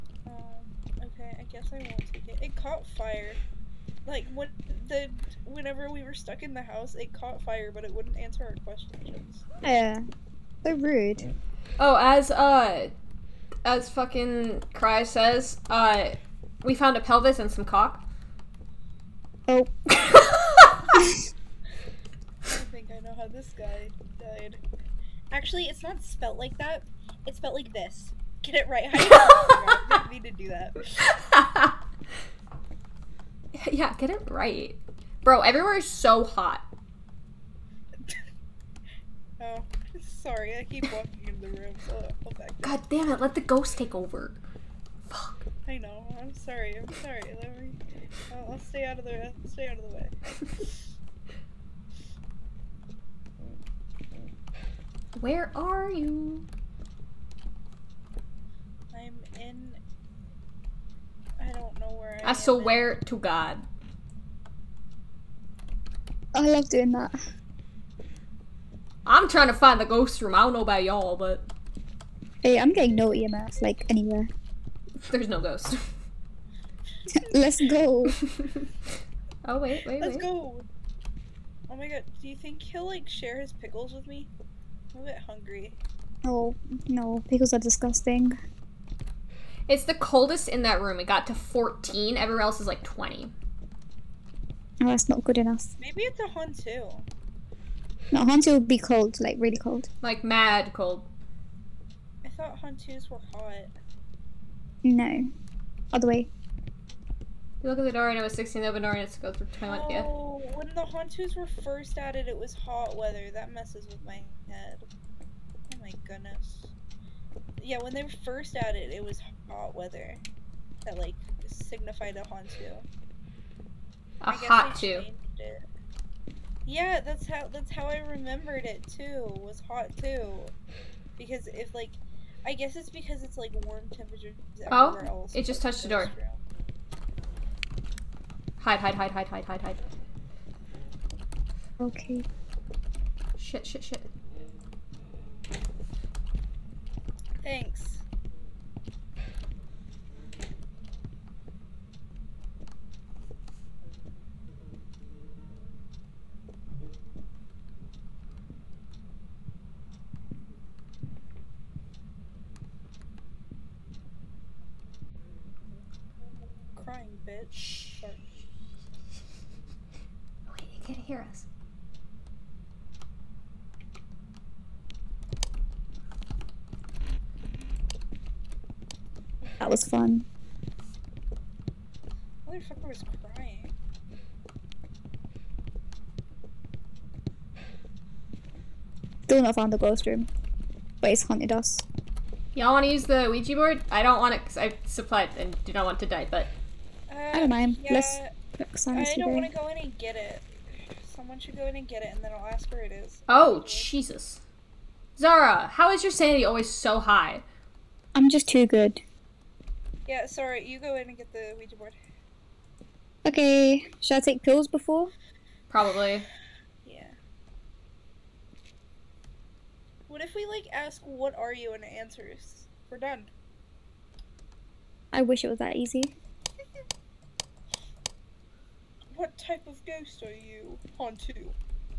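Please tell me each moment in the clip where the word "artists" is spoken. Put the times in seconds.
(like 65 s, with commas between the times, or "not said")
not said.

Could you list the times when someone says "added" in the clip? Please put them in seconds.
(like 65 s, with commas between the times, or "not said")
111 s, 118 s.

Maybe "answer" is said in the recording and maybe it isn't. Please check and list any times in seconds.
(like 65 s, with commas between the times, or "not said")
8 s, 221 s.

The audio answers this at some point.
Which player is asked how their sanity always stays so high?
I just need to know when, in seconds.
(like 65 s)
205 s.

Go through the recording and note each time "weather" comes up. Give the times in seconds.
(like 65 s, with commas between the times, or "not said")
112 s, 119 s.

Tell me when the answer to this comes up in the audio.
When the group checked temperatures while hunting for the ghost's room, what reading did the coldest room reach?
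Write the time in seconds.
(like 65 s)
91 s.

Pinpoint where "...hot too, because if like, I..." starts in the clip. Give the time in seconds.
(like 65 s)
129 s.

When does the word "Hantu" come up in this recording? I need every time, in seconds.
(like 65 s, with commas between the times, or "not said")
98 s, 102 s, 110 s, 122 s.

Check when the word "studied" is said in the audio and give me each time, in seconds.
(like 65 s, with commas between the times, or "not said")
not said.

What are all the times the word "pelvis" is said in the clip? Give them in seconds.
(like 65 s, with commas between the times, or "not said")
17 s.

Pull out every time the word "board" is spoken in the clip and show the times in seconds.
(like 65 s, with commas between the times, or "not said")
193 s, 211 s.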